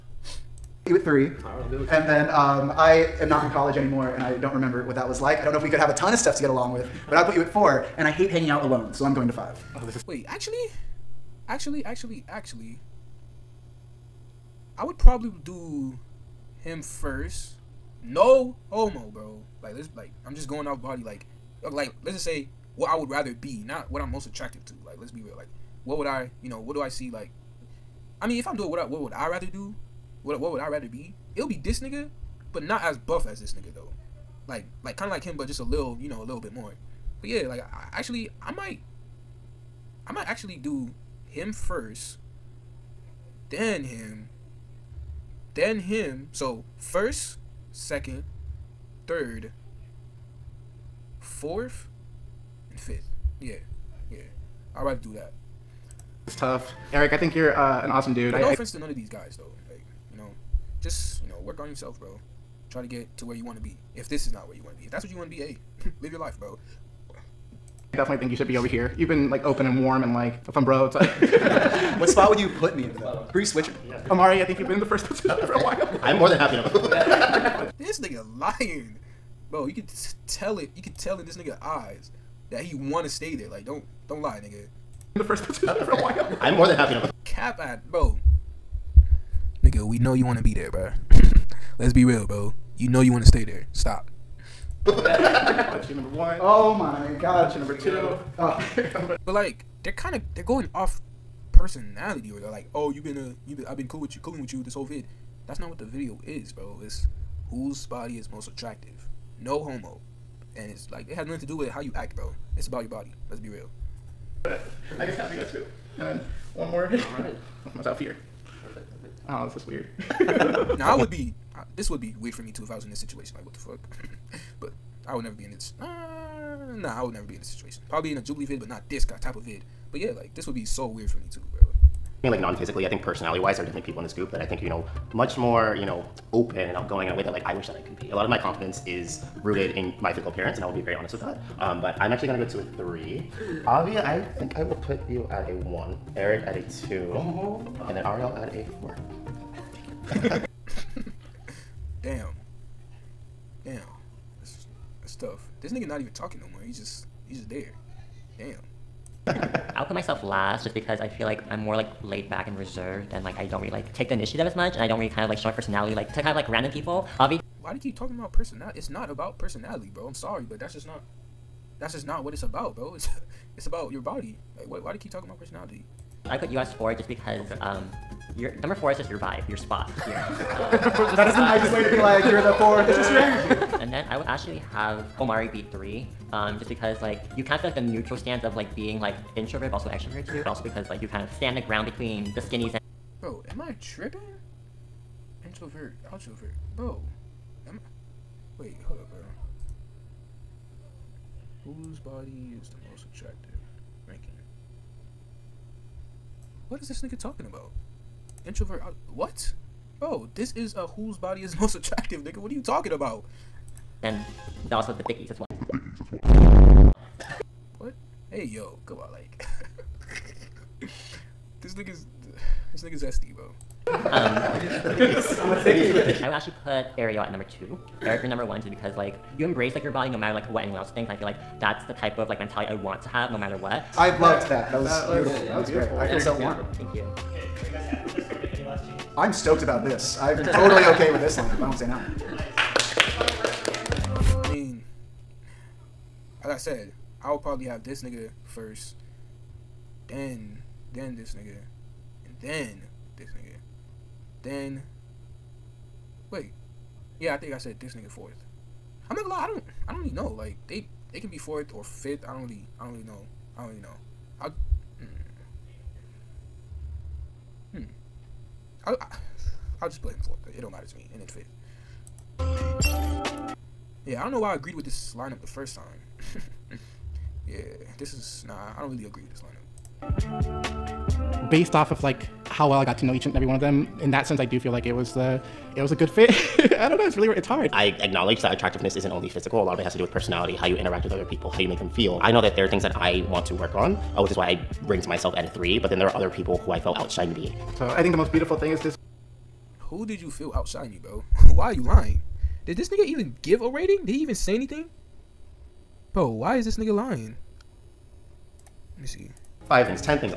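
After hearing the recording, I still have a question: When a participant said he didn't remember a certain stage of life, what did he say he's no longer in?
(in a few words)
College.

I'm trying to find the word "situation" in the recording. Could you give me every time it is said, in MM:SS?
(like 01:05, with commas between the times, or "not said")
02:02, 02:07.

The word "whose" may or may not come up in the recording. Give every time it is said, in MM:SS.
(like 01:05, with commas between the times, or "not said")
01:47, 03:21, 03:30.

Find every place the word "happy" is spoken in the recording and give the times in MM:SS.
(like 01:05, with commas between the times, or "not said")
01:16, 01:26.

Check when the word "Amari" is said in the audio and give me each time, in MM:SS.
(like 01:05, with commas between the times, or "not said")
01:14.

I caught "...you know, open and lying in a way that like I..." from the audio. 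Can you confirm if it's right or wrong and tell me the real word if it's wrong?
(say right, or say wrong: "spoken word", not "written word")
wrong: "outgoing", not "lying".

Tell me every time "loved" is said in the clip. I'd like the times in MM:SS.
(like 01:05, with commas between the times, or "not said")
03:54.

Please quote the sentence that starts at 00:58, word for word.
to none of these guys, though.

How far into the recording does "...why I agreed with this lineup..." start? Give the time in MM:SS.
04:34.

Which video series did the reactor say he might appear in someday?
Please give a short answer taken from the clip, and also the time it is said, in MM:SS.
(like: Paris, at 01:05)
Jubilee, at 02:08.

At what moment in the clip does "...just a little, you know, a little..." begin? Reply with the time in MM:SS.
00:35.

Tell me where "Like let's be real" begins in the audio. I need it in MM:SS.
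00:24.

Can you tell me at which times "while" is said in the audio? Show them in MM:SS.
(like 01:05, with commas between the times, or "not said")
01:15, 01:26.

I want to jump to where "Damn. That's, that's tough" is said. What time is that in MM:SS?
02:33.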